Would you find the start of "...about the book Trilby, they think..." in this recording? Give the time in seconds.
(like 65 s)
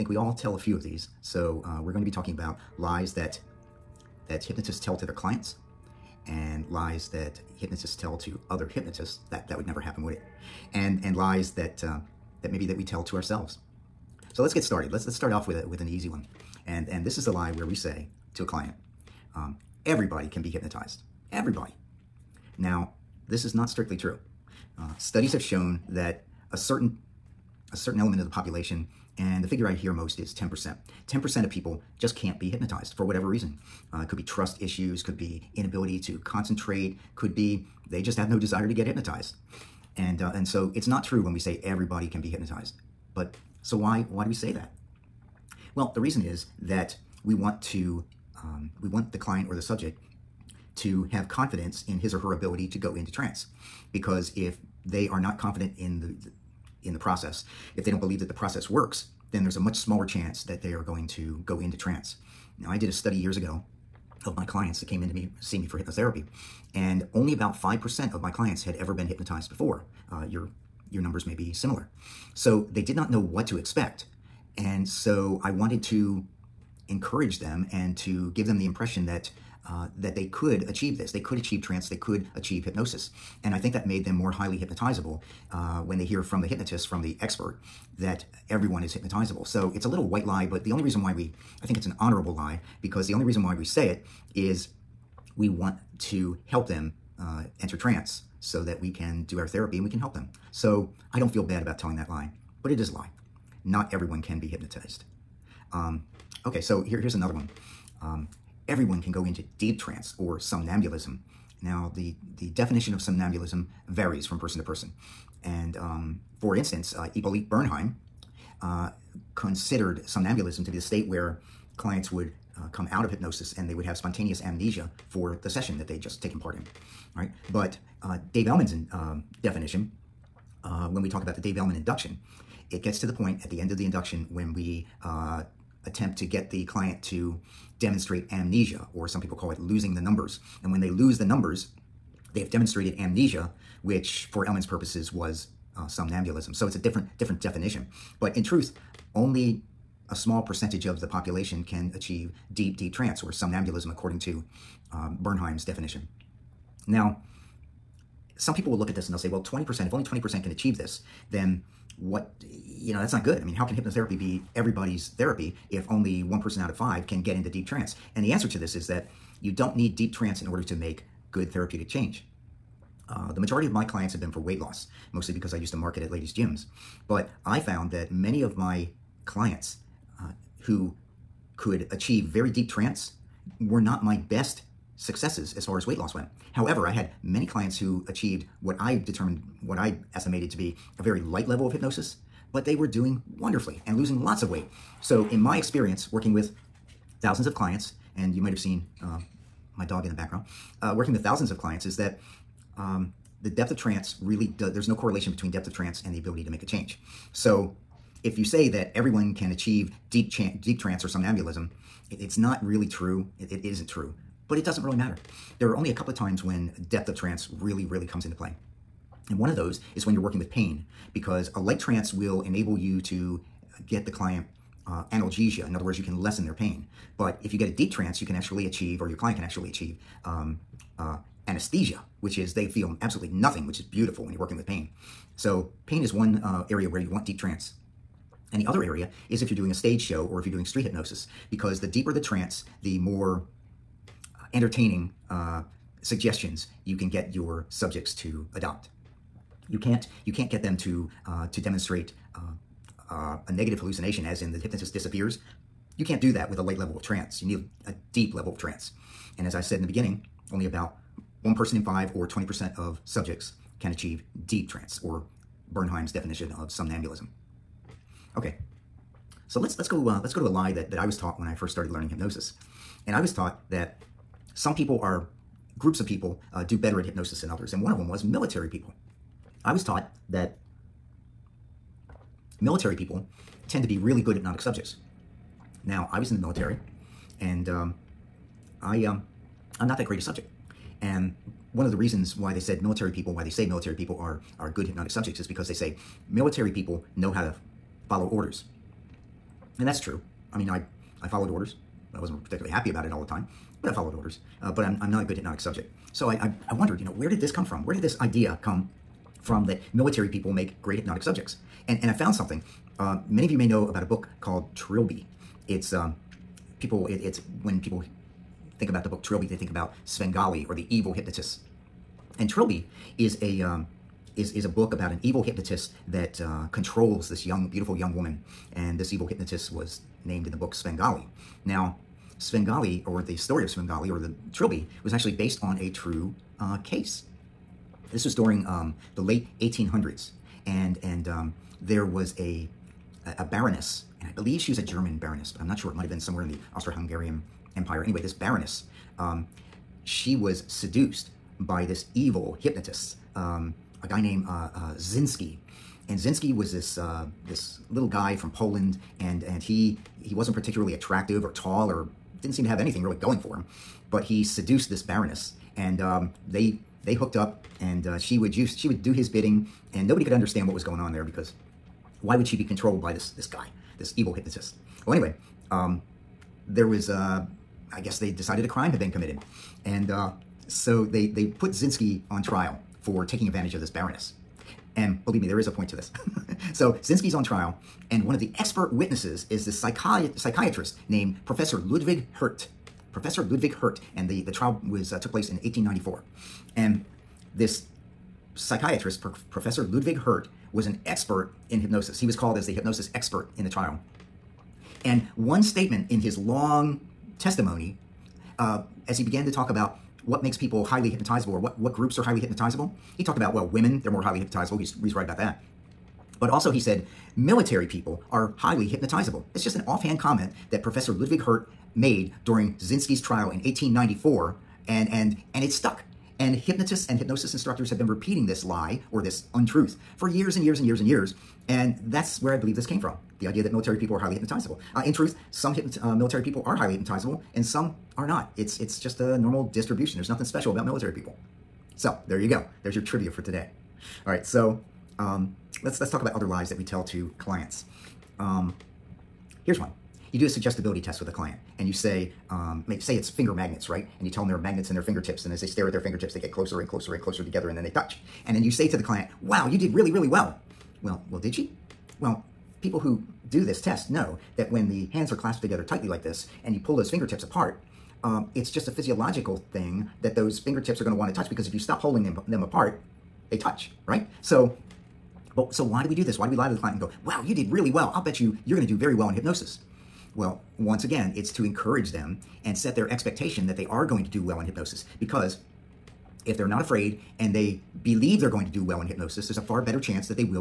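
318 s.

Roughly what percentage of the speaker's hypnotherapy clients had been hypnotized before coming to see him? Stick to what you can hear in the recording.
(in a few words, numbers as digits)
5%.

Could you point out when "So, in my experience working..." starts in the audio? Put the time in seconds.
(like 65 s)
194 s.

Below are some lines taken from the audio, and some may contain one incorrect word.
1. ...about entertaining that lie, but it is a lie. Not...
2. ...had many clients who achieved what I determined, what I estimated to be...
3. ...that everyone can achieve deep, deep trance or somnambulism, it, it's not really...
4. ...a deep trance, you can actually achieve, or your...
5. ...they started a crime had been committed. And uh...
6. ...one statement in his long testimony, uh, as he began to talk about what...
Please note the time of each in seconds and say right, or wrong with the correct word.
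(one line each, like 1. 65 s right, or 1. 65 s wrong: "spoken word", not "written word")
1. 101 s wrong: "telling", not "entertaining"
2. 186 s right
3. 208 s right
4. 227 s right
5. 378 s wrong: "decided", not "started"
6. 405 s right.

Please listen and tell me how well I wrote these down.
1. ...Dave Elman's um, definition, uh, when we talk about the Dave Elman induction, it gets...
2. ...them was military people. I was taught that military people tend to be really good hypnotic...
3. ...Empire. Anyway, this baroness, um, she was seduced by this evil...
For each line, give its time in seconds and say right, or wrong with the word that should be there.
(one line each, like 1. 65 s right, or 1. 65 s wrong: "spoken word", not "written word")
1. 128 s right
2. 277 s right
3. 347 s right.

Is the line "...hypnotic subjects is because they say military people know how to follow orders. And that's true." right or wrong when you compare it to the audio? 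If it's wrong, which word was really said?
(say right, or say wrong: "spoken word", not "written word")
right.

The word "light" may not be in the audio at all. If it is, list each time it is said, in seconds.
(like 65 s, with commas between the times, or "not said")
191 s, 221 s, 256 s.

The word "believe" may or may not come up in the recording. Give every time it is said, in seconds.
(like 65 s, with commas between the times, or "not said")
57 s, 344 s, 385 s, 432 s, 488 s.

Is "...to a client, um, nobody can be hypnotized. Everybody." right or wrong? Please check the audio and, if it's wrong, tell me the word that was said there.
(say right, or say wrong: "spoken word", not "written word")
wrong: "everybody", not "nobody".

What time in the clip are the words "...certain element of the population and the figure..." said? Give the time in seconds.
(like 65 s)
27 s.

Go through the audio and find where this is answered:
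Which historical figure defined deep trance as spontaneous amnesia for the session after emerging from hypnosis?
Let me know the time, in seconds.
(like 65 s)
117 s.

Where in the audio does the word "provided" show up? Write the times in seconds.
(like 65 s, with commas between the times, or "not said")
not said.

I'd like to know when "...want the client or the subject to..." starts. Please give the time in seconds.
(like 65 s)
48 s.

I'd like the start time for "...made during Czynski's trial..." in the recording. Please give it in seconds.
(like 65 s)
421 s.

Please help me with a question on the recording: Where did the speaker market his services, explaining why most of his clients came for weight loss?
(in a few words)
ladies' gyms.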